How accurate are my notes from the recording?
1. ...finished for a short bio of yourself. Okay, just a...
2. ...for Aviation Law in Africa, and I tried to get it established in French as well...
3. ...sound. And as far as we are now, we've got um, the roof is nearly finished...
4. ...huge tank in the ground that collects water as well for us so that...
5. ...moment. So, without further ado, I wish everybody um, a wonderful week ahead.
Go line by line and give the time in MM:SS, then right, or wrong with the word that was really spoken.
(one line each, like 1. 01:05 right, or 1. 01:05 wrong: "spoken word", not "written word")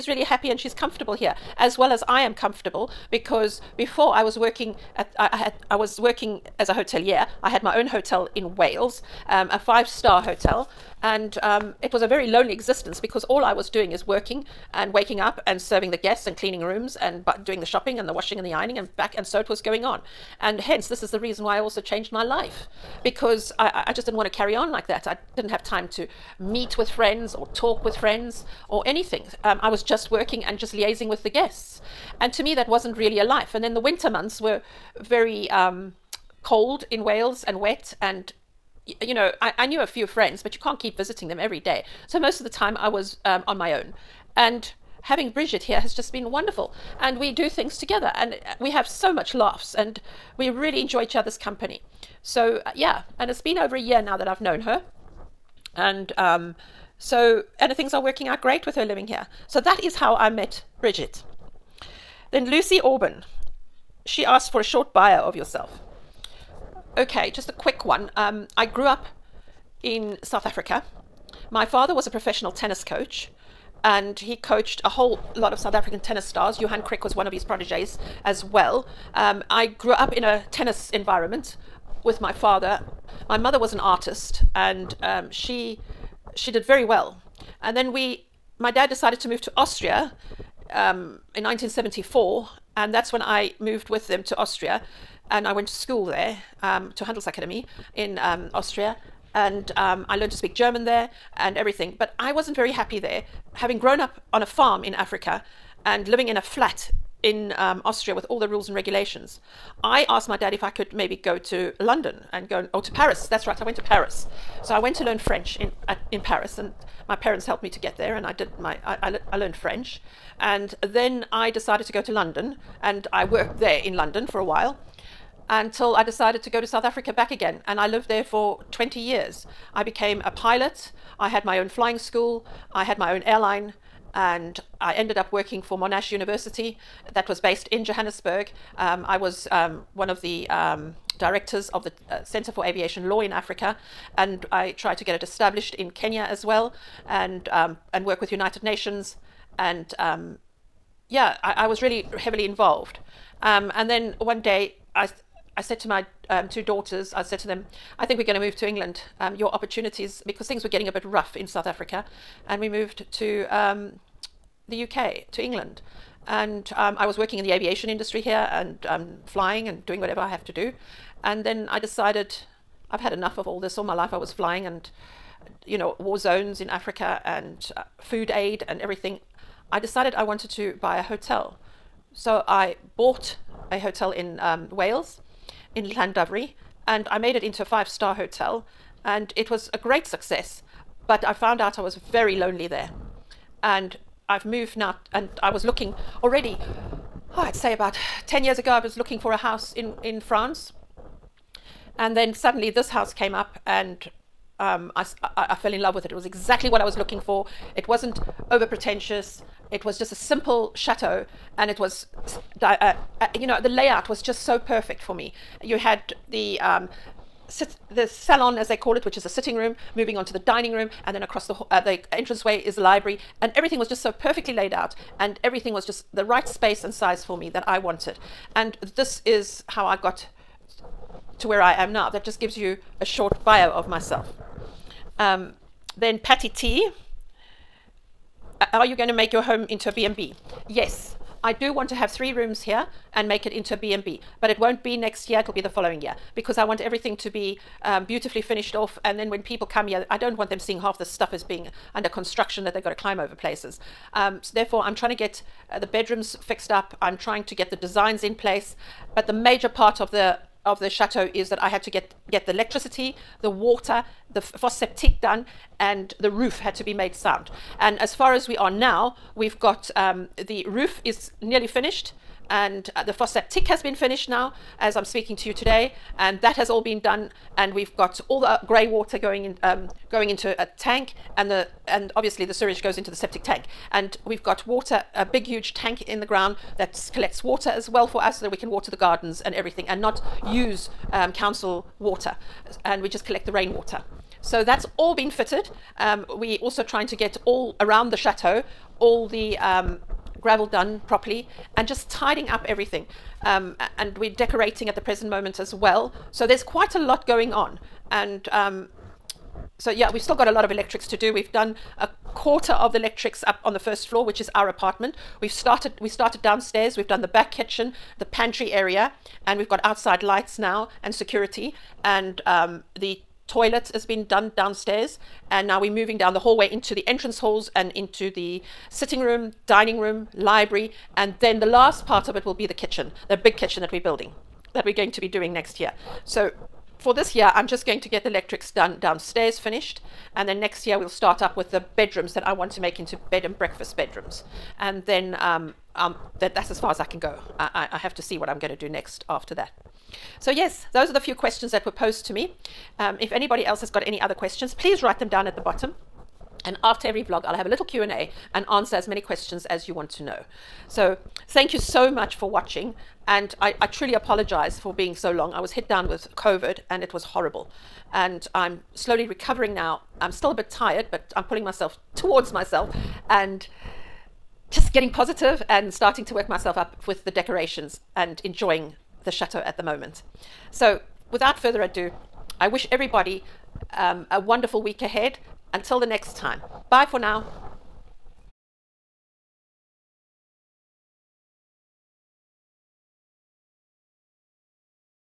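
1. 01:04 wrong: "asked", not "finished"
2. 02:22 wrong: "Kenya", not "French"
3. 04:27 right
4. 04:45 right
5. 06:19 right.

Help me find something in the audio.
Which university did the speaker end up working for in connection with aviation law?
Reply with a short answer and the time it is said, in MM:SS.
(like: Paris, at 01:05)
Monash University, at 02:15.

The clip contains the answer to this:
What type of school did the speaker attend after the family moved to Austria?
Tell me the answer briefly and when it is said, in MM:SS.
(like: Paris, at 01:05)
Handelsakademie, at 01:37.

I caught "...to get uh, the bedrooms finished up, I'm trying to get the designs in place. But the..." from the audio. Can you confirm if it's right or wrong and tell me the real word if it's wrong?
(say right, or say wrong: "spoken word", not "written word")
wrong: "fixed", not "finished".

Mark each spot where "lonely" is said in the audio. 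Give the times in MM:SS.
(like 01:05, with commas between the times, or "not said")
00:12, 03:12.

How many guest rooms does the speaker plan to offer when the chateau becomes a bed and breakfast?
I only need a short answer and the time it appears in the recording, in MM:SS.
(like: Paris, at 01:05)
3, at 04:02.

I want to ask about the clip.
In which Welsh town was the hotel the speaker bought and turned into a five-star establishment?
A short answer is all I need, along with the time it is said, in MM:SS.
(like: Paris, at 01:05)
Llandovery, at 03:05.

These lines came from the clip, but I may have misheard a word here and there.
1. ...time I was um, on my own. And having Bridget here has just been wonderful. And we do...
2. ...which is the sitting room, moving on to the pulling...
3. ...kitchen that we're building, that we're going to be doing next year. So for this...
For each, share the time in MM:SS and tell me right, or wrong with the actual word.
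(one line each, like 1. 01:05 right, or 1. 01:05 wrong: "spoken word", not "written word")
1. 00:42 right
2. 03:39 wrong: "dining", not "pulling"
3. 05:33 right.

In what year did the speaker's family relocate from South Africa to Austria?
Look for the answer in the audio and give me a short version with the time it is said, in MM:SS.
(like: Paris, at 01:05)
1974, at 01:31.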